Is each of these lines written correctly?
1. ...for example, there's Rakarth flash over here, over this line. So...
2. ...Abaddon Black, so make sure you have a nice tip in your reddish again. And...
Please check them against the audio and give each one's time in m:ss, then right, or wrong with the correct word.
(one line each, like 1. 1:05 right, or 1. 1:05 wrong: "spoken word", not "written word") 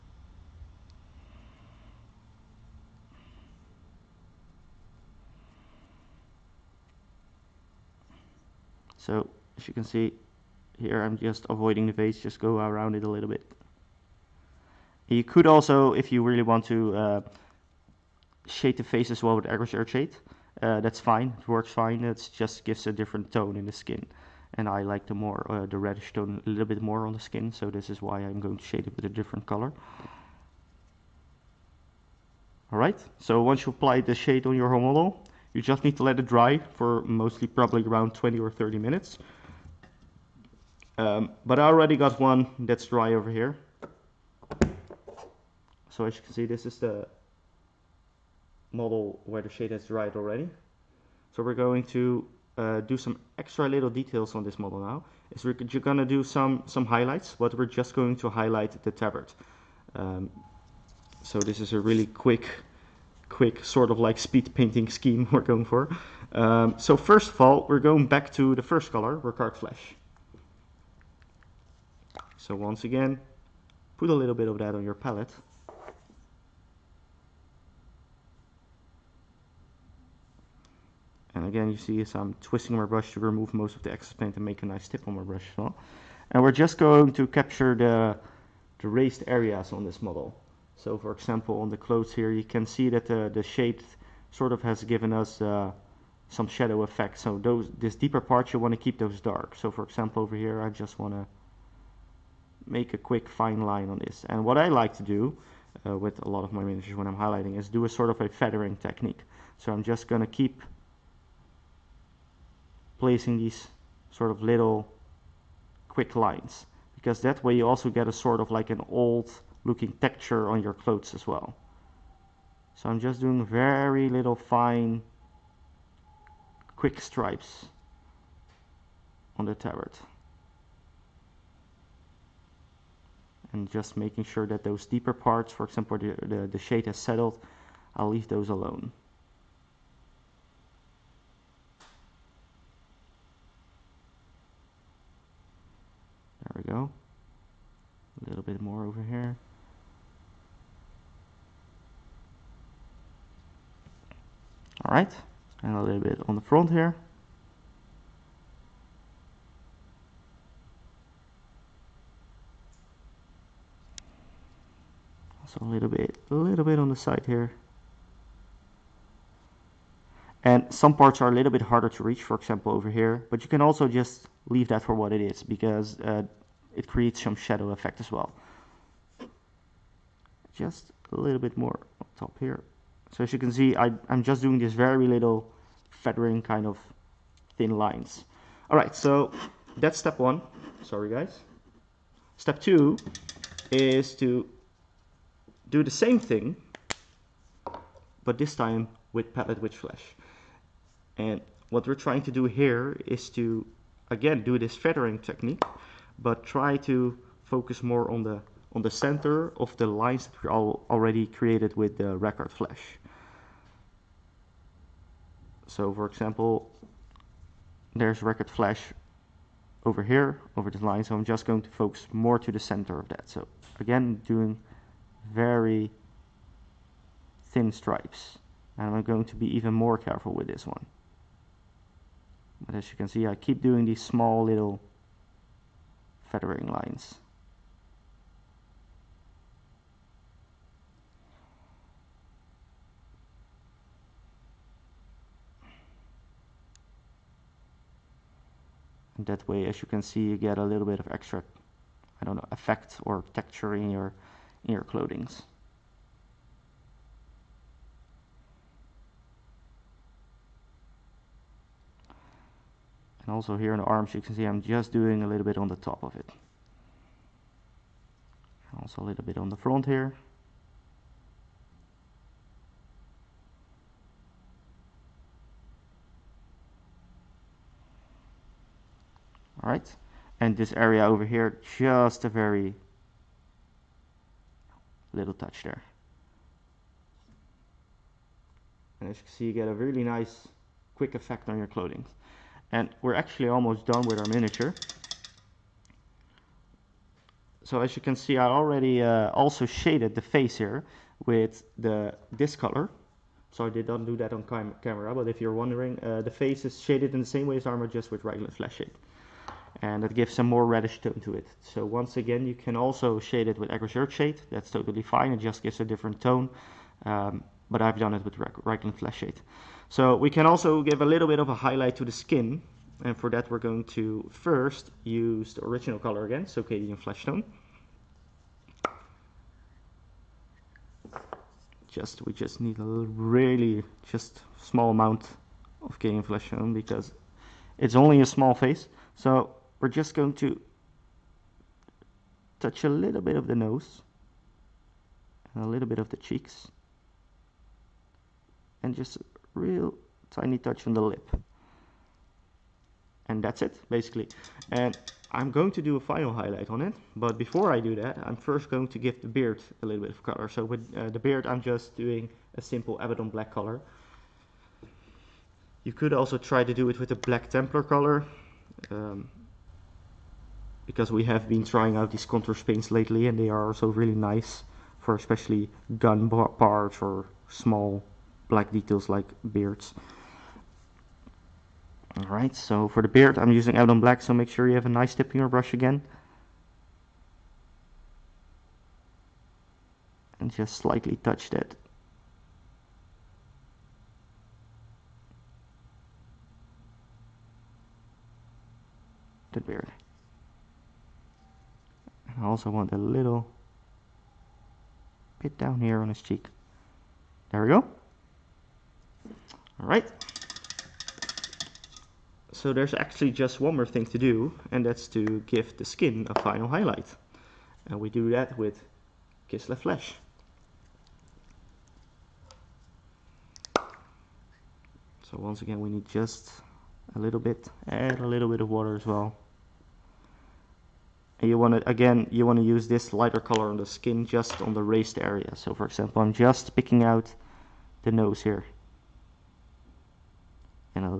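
1. 3:35 right
2. 6:23 wrong: "brush", not "reddish".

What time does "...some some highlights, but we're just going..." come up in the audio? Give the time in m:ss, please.
0:56.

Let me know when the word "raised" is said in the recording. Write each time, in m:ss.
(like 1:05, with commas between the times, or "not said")
1:28, 7:14.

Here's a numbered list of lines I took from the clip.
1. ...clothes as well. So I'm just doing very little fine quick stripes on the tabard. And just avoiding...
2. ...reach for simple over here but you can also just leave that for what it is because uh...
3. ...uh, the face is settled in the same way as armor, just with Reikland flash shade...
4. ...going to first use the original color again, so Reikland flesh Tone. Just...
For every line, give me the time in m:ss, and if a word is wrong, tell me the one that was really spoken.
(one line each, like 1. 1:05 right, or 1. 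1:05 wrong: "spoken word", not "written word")
1. 2:00 wrong: "making", not "avoiding"
2. 2:52 wrong: "example", not "simple"
3. 5:06 wrong: "shaded", not "settled"
4. 5:23 wrong: "Cadian", not "Reikland".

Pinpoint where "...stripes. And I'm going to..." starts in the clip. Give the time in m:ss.
3:47.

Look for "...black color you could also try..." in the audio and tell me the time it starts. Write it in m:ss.
6:03.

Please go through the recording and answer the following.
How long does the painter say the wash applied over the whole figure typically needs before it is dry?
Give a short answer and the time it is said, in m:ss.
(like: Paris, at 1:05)
20 or 30 minutes, at 0:38.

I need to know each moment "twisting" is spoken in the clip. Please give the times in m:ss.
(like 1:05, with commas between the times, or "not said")
1:22.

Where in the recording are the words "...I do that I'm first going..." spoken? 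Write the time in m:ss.
5:57.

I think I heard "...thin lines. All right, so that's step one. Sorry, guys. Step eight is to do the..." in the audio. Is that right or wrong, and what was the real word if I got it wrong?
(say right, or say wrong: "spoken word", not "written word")
wrong: "two", not "eight".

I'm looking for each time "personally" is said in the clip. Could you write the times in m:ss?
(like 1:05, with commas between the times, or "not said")
not said.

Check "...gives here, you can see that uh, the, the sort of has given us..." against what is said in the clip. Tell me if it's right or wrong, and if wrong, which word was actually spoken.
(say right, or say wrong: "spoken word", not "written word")
wrong: "clothes", not "gives".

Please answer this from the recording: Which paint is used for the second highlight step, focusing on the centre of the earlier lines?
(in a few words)
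Pallid Wych Flesh.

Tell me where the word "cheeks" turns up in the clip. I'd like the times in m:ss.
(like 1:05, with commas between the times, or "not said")
5:46, 6:46.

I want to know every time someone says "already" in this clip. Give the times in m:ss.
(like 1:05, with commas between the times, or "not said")
0:41, 0:50, 3:30, 4:58.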